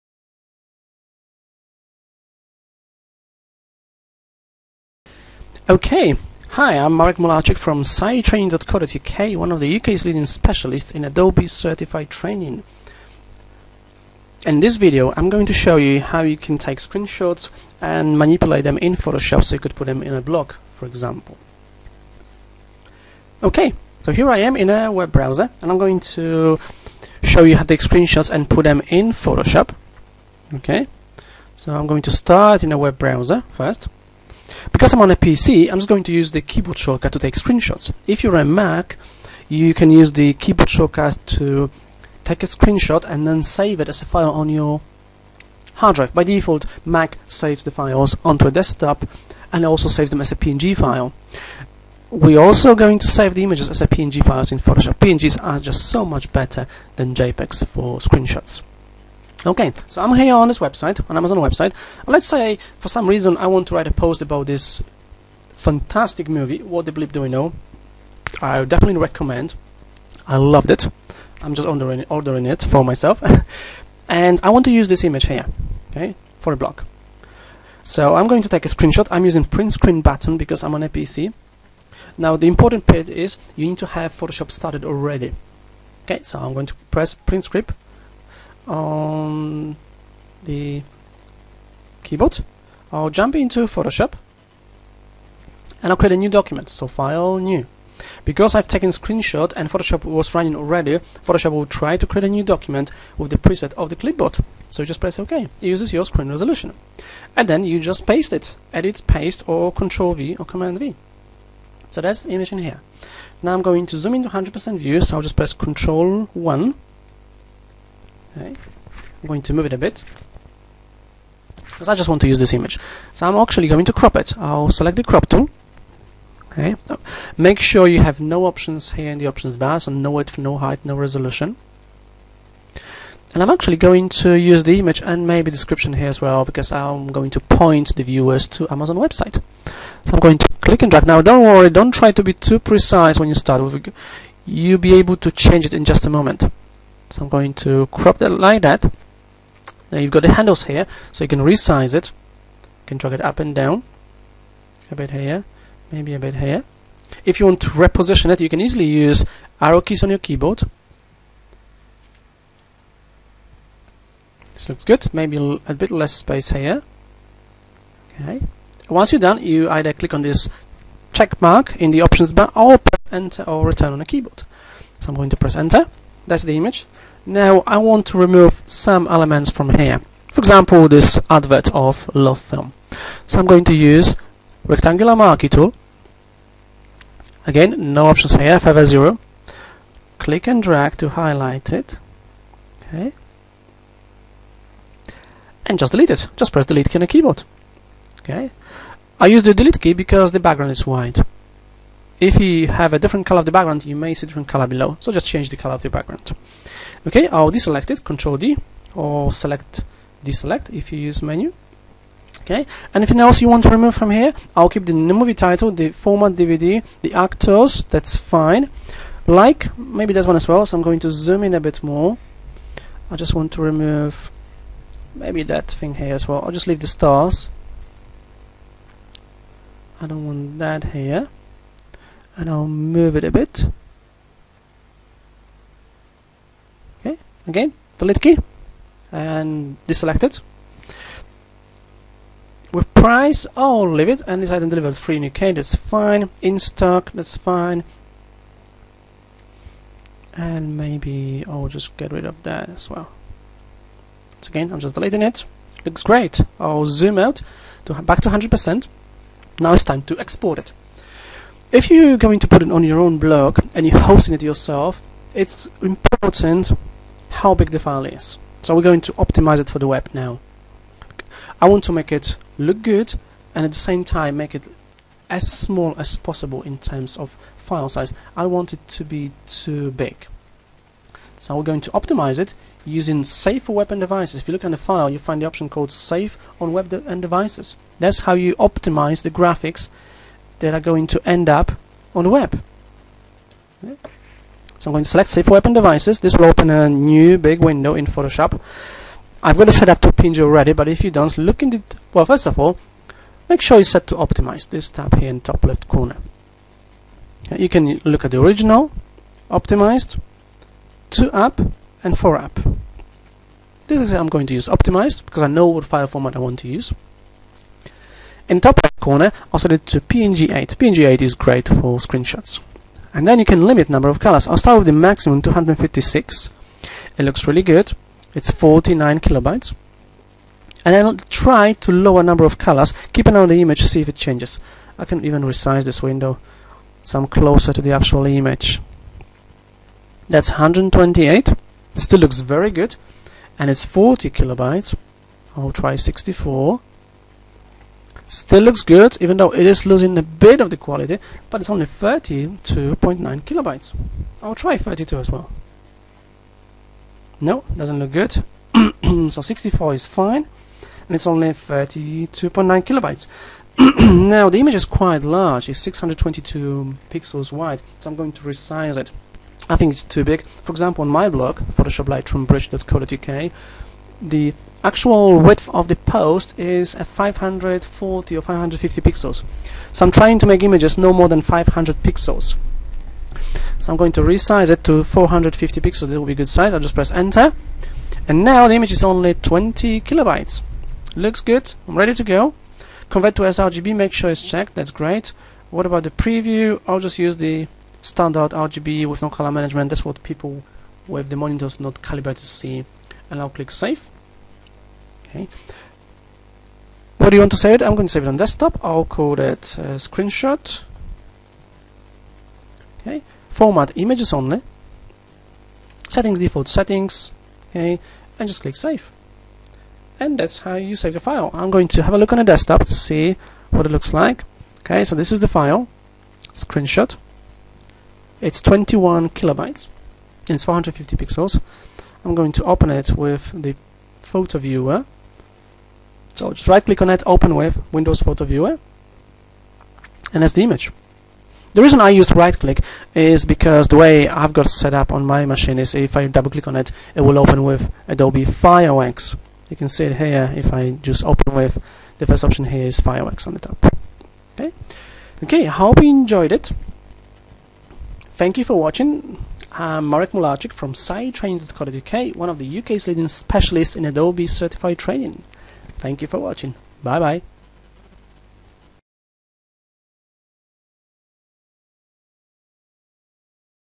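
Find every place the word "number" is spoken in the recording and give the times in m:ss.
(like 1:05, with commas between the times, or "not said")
5:23, 5:32.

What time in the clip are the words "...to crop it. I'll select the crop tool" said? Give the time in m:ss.
2:03.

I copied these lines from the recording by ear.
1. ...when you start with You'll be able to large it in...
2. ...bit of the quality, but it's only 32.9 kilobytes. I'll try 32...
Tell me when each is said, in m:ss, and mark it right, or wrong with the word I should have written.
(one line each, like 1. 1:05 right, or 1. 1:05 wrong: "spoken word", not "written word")
1. 2:23 wrong: "change", not "large"
2. 5:50 right.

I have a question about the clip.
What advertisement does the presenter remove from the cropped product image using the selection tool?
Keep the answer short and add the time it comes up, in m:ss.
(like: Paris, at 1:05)
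LoveFilm, at 3:02.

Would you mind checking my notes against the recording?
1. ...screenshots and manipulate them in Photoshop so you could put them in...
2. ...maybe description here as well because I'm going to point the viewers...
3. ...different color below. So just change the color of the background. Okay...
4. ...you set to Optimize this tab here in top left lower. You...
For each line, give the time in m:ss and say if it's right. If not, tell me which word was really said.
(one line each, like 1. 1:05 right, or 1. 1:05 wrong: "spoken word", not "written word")
1. 0:16 right
2. 2:15 right
3. 3:24 right
4. 5:03 wrong: "corner", not "lower".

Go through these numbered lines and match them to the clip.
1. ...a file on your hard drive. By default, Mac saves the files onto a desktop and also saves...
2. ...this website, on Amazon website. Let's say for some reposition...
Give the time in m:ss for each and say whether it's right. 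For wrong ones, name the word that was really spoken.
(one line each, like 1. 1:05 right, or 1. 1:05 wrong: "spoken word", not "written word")
1. 0:44 right
2. 1:00 wrong: "reason", not "reposition".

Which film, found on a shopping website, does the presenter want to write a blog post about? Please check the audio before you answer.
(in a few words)
What the Bleep Do We Know.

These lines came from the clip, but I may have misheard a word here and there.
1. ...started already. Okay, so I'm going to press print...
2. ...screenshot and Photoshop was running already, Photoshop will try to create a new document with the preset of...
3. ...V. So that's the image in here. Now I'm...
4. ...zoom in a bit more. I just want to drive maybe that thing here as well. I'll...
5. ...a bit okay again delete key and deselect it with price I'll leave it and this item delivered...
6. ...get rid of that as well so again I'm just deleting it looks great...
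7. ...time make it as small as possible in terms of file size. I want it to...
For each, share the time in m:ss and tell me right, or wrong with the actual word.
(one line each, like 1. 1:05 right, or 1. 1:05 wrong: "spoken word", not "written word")
1. 1:24 right
2. 1:38 right
3. 1:50 right
4. 3:41 wrong: "remove", not "drive"
5. 3:53 right
6. 4:11 right
7. 4:34 right.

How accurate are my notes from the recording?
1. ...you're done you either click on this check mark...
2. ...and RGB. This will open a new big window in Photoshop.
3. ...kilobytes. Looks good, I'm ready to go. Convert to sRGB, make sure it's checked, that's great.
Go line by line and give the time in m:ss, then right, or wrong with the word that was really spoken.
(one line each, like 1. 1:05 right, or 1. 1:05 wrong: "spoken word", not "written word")
1. 2:49 right
2. 4:55 wrong: "Devices", not "RGB"
3. 6:30 right.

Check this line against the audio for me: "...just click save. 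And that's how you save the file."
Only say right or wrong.
right.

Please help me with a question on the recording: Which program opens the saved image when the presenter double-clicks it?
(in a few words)
Adobe Fireworks.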